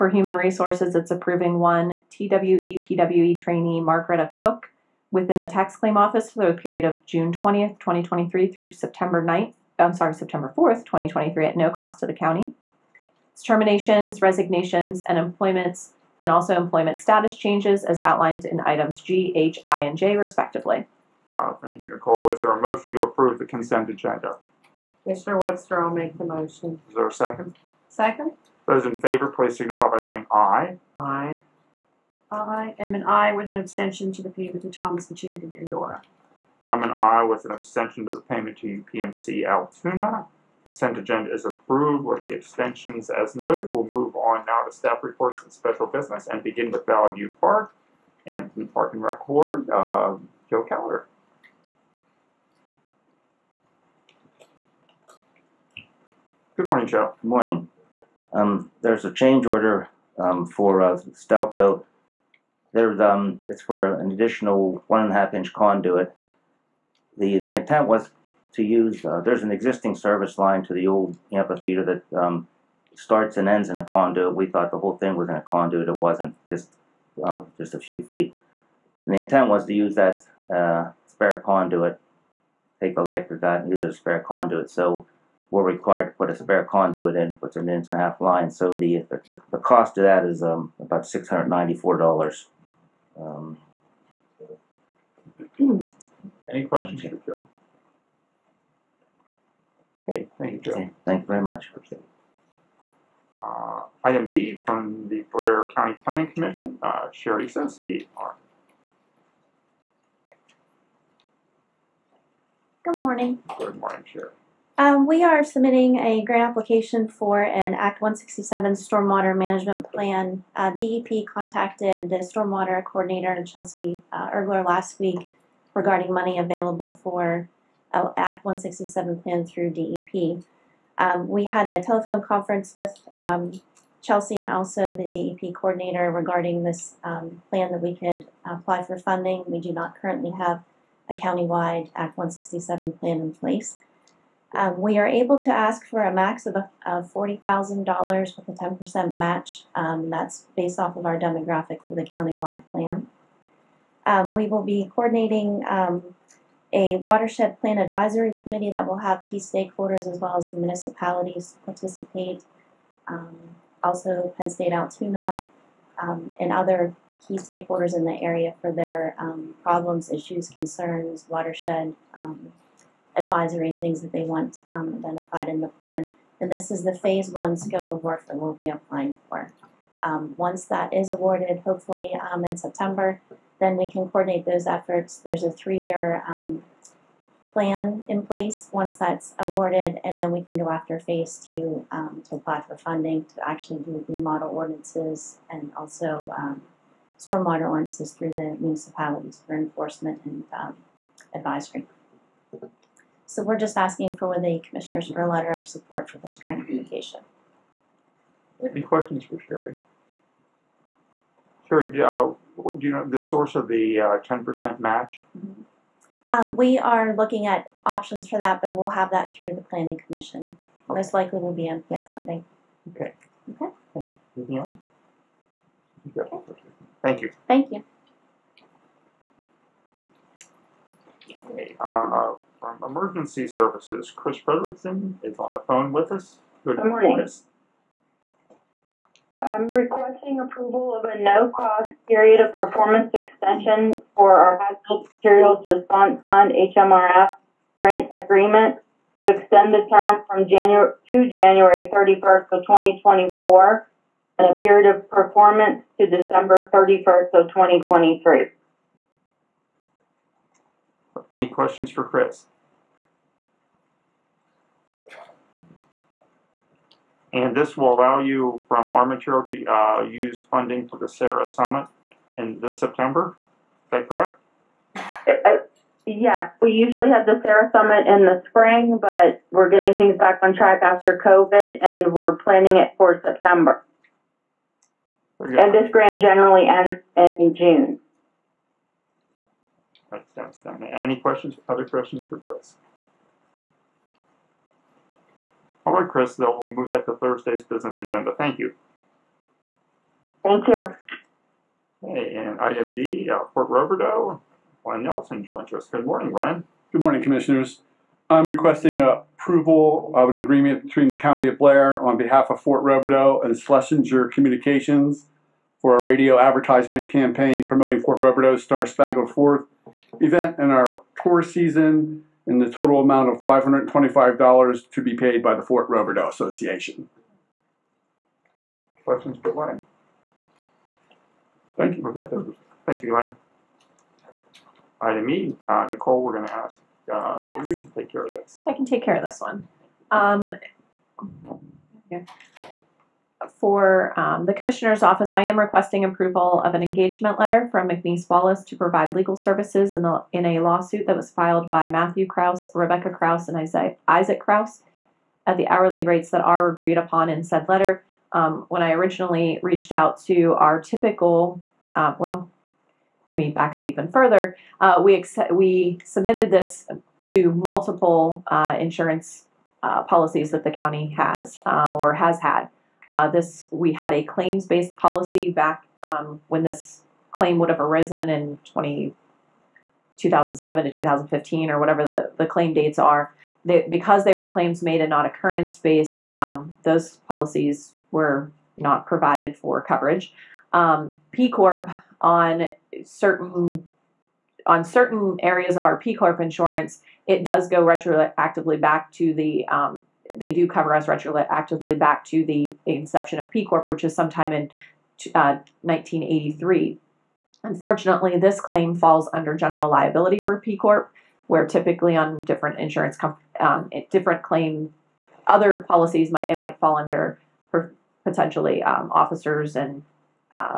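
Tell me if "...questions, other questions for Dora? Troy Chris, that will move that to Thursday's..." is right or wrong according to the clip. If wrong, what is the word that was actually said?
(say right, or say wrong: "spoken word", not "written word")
wrong: "Chris", not "Dora".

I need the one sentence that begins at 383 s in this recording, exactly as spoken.
They, because they were claims made and not occurrence-based, um, those policies were not provided for coverage.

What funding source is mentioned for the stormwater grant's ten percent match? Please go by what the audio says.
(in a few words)
MPO funding.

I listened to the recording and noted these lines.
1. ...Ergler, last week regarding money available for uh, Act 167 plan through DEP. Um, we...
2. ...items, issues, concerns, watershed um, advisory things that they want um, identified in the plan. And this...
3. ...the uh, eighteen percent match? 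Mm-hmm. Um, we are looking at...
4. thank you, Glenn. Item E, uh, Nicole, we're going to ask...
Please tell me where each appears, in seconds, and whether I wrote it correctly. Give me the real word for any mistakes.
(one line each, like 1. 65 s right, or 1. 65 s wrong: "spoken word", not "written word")
1. 124 s right
2. 169 s wrong: "problems", not "items"
3. 213 s wrong: "ten", not "eighteen"
4. 332 s right.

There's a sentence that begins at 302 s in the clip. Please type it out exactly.
Hey, and IMD D, uh, Fort Roberdeau, Ryan Nelson joins us.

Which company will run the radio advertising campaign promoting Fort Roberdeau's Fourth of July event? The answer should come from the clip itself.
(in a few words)
Schlesinger Communications.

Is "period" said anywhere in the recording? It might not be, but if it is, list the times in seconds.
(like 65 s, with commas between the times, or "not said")
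6 s, 242 s, 254 s.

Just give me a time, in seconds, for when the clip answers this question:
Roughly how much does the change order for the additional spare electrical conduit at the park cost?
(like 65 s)
91 s.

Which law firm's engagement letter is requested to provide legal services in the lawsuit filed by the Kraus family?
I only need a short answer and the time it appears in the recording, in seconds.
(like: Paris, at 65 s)
McNees Wallace, at 347 s.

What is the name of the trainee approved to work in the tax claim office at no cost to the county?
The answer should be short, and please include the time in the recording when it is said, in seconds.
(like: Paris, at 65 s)
Margaretta Cook, at 3 s.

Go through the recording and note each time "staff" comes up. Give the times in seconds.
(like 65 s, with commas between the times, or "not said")
44 s.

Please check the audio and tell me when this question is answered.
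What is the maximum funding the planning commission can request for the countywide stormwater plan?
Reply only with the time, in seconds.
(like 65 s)
147 s.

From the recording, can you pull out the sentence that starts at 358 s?
Um, when I originally reached out to our typical, uh, well, let me back up even further.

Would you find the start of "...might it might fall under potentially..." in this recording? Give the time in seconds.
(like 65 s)
416 s.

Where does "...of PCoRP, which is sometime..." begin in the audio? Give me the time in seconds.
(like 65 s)
403 s.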